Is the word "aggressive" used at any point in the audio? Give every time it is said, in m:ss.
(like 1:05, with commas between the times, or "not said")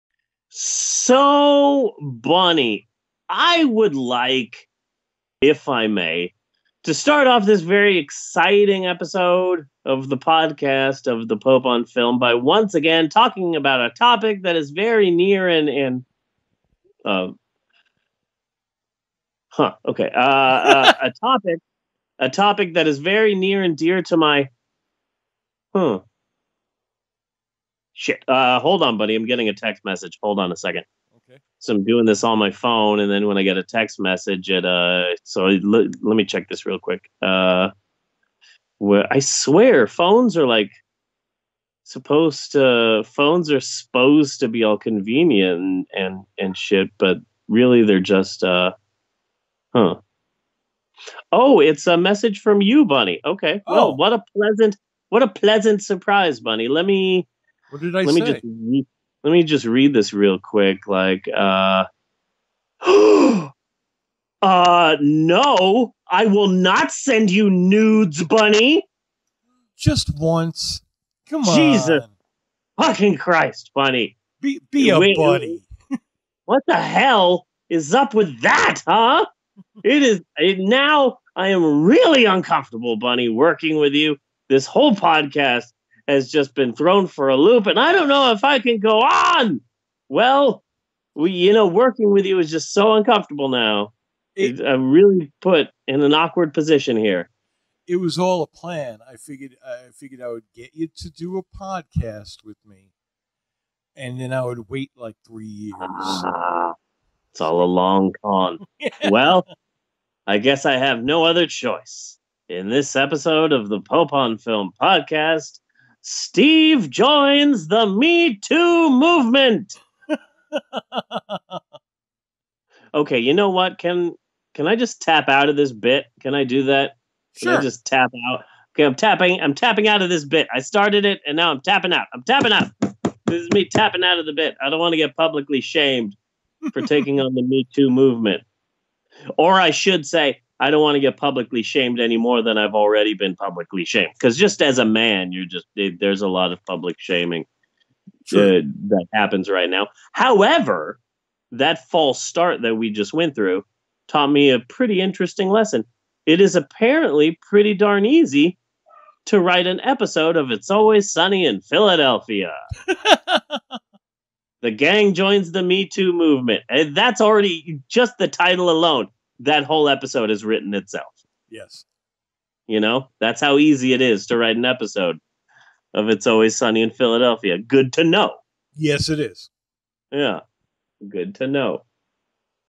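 not said.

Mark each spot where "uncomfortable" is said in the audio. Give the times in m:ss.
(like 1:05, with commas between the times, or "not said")
1:22, 1:32.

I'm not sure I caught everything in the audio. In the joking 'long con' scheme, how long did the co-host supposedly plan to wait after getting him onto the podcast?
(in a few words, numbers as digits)
3 years.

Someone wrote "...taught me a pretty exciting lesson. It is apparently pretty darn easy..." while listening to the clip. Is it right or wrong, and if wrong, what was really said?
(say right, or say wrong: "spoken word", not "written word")
wrong: "interesting", not "exciting".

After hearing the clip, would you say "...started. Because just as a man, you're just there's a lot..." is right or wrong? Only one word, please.
wrong.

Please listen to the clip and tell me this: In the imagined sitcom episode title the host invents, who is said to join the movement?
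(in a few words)
The gang.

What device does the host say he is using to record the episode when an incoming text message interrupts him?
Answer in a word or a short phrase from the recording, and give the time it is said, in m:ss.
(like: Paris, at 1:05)
My phone, at 0:32.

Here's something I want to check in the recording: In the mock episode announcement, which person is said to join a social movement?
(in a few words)
Steve.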